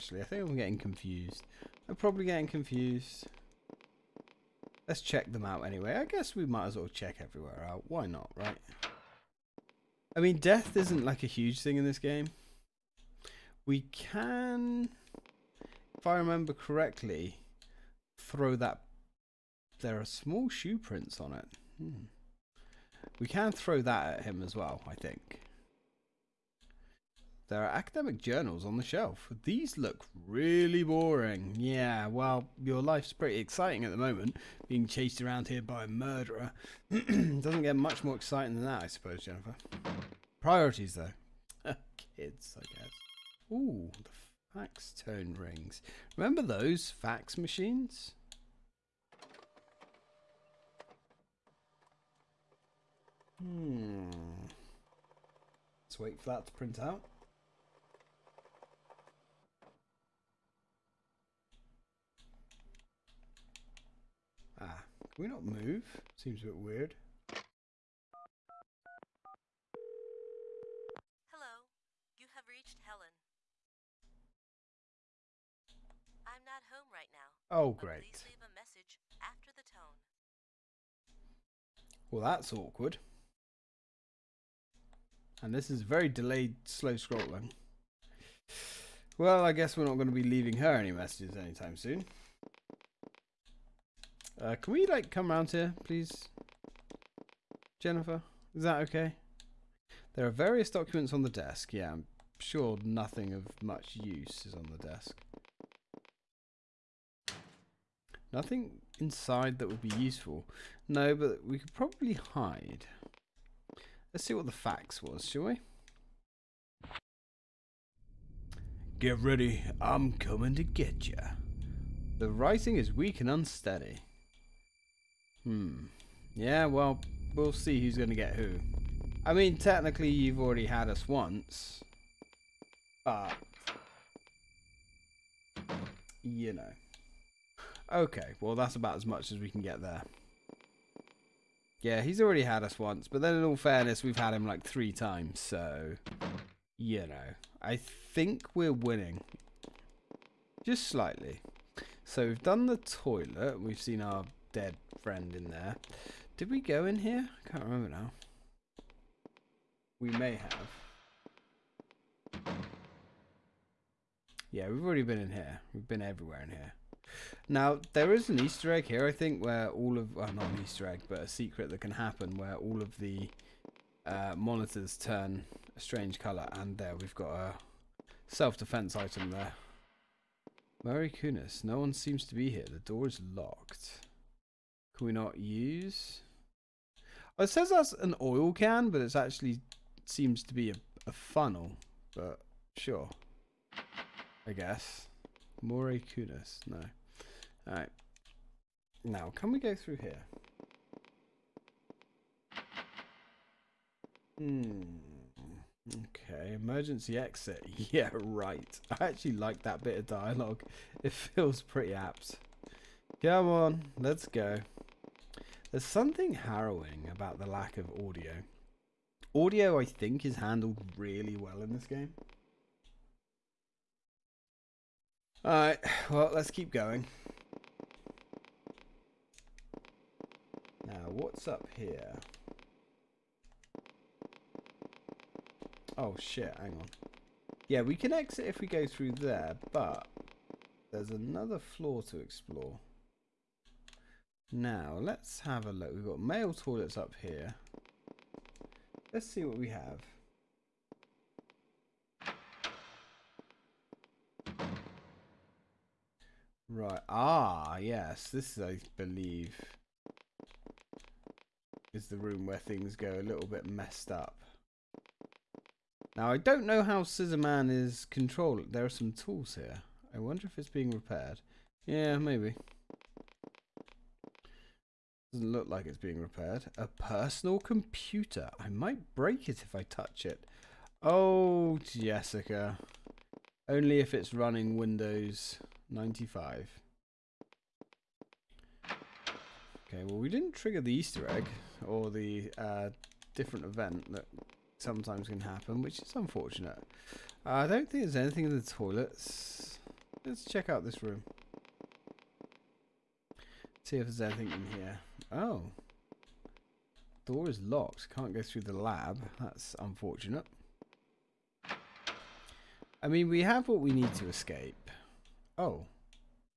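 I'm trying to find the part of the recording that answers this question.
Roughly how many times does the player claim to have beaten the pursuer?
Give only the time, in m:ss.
2:24.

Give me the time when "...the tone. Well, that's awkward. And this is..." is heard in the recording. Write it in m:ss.
1:19.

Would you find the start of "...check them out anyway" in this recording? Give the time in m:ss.
0:05.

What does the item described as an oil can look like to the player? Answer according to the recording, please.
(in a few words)
a funnel.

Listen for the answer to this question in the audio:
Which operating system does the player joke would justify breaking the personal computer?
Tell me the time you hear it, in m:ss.
4:44.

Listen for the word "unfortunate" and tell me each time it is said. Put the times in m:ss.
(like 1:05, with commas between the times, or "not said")
4:56, 5:09.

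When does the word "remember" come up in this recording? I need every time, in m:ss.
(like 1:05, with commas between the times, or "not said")
0:16, 0:46, 2:37.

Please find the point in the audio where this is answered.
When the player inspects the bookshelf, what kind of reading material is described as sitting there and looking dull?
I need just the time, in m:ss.
0:27.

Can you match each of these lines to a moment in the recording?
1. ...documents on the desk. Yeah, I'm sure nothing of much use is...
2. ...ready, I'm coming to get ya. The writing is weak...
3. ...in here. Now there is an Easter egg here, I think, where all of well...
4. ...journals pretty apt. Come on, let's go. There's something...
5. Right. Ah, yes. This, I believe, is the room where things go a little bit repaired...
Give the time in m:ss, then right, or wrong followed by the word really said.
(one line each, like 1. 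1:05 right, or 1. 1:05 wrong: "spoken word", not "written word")
1. 1:40 right
2. 1:59 right
3. 2:46 right
4. 3:31 wrong: "feels", not "journals"
5. 4:16 wrong: "messed", not "repaired".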